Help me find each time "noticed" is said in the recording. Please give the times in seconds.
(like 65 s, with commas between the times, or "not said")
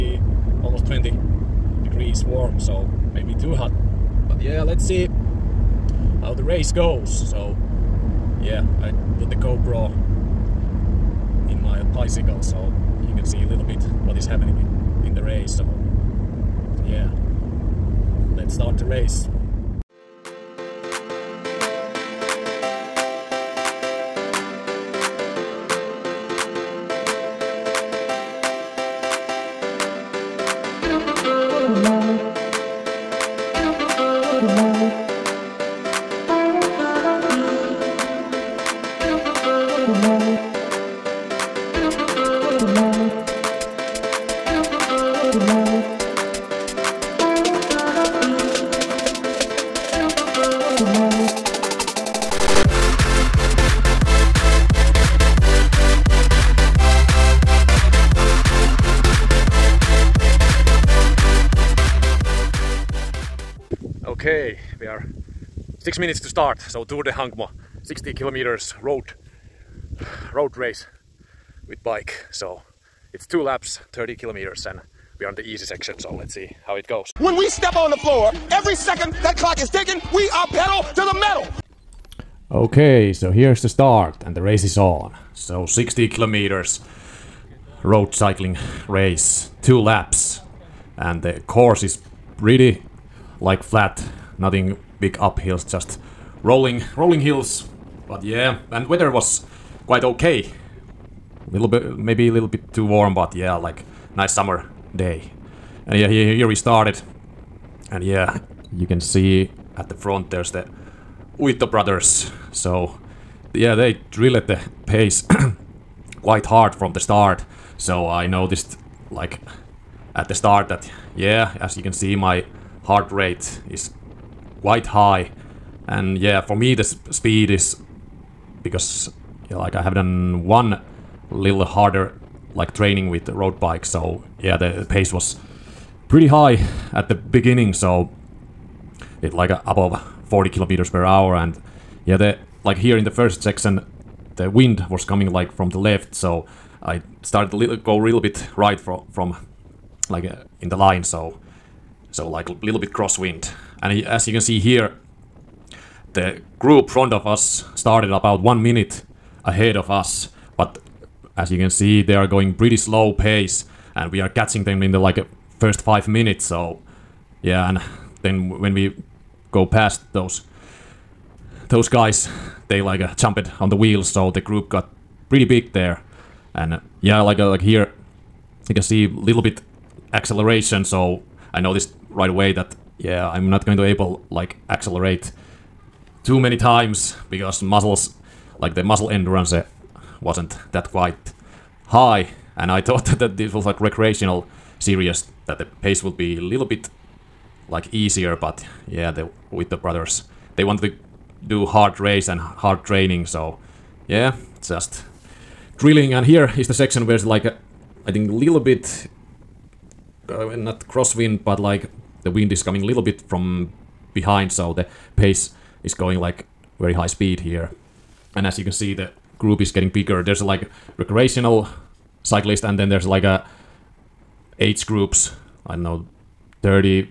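118 s, 181 s.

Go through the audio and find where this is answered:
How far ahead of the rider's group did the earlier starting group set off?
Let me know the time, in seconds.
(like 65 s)
158 s.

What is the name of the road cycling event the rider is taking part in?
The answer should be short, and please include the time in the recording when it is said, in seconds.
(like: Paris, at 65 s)
Tour de Hankmo, at 66 s.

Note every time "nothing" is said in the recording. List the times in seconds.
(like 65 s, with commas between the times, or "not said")
94 s.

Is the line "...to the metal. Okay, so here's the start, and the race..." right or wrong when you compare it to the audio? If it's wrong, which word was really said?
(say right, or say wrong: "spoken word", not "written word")
right.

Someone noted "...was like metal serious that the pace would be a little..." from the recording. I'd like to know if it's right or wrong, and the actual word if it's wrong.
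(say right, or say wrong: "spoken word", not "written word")
wrong: "recreational", not "metal".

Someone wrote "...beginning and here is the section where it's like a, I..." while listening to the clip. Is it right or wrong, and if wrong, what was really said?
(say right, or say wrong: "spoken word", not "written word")
wrong: "drilling", not "beginning".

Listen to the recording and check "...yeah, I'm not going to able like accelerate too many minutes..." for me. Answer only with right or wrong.
wrong.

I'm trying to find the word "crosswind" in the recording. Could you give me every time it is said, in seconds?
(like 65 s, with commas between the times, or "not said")
152 s, 210 s.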